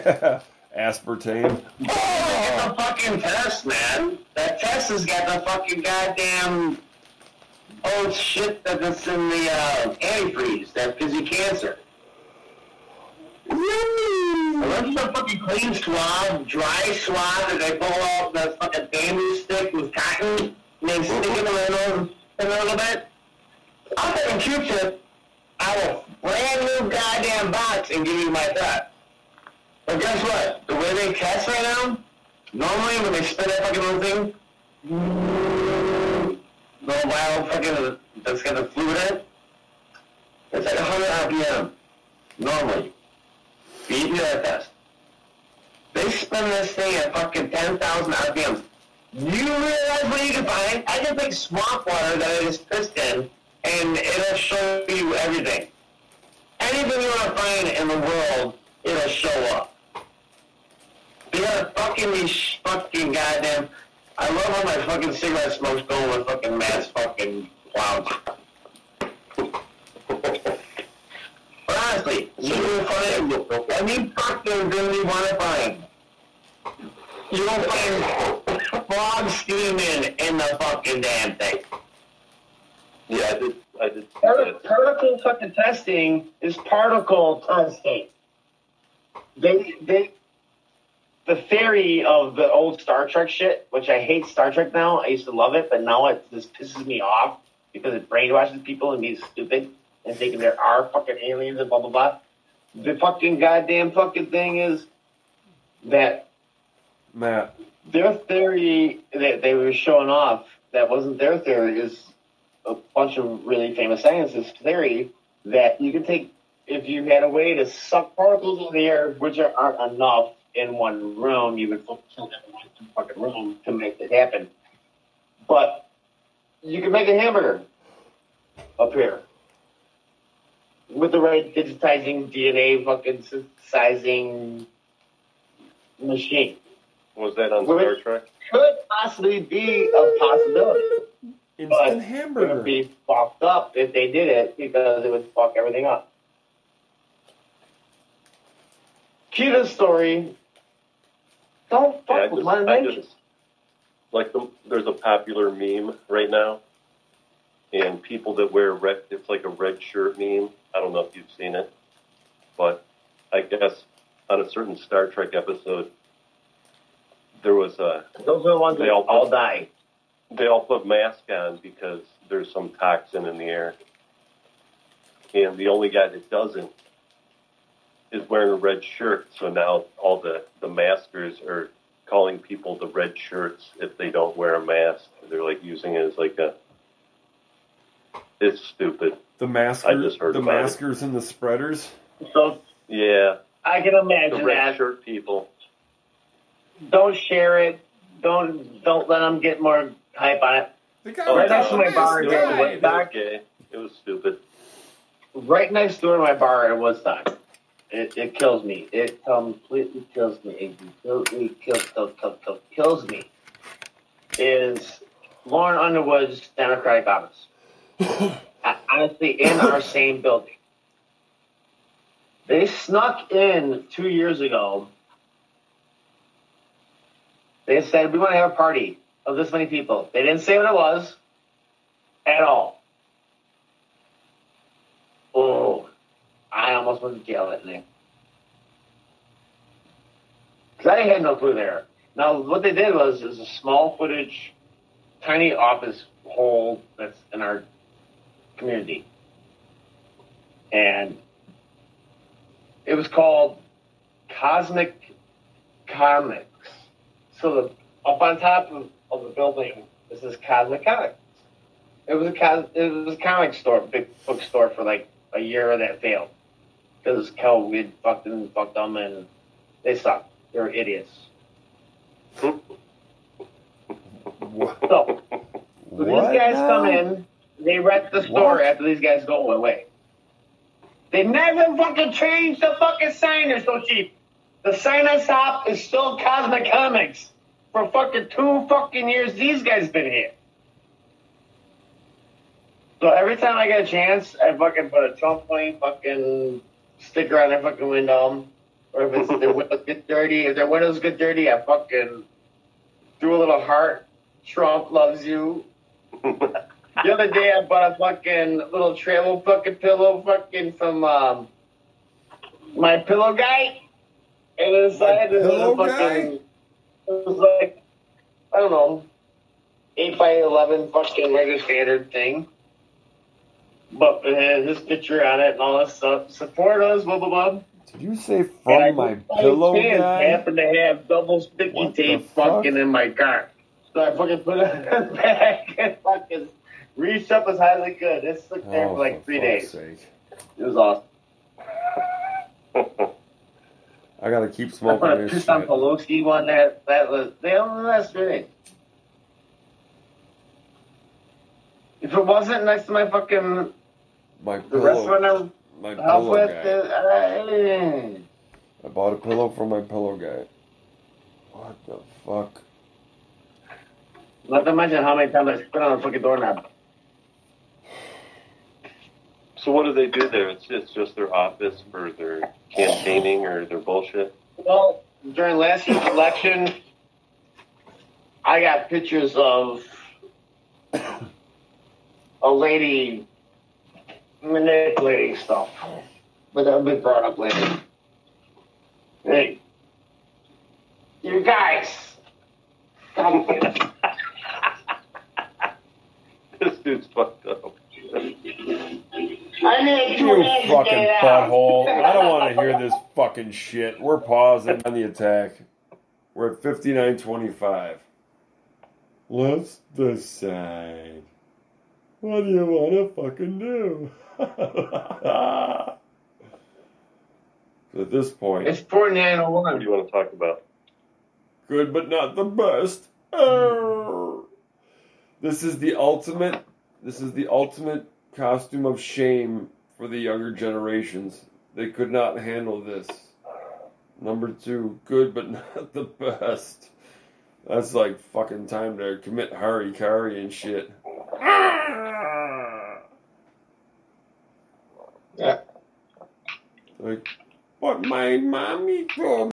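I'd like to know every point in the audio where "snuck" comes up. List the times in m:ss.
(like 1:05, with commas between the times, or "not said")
3:42.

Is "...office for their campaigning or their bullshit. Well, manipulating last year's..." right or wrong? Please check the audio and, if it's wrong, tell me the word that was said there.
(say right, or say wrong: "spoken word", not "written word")
wrong: "during", not "manipulating".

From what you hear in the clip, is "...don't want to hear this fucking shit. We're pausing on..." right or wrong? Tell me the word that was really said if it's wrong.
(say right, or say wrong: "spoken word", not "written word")
right.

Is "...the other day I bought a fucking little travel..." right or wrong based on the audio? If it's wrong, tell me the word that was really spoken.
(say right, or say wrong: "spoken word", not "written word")
right.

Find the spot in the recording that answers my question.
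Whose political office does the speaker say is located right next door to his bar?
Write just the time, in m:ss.
3:35.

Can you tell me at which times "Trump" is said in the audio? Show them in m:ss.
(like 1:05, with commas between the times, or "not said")
4:55, 5:04.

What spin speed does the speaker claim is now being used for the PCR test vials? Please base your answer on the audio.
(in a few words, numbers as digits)
10,000 RPMs.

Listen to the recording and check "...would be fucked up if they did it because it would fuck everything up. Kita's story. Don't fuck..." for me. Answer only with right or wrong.
right.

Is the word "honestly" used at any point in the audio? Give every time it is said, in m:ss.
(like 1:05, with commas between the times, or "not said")
1:11, 3:38.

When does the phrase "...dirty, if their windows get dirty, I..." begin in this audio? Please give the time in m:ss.
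5:00.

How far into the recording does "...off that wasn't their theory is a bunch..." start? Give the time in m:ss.
1:50.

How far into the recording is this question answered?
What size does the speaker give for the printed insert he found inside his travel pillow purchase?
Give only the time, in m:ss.
5:19.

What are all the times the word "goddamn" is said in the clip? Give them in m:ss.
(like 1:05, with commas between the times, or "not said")
0:05, 0:26, 1:03, 1:43.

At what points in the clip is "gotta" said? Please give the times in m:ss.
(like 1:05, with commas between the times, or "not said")
5:44.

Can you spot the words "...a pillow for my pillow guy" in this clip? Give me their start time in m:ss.
5:59.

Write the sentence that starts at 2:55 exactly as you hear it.
And the only guy that doesn't is wearing a red shirt.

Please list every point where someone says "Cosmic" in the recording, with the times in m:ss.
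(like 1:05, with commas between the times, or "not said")
4:14, 4:20, 4:46.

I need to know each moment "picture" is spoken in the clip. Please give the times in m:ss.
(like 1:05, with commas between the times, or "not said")
5:24, 6:18.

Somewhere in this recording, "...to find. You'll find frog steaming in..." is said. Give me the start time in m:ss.
1:15.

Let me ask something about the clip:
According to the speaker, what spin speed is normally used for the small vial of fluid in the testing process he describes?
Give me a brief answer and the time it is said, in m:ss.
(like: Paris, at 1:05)
100 RPM, at 0:40.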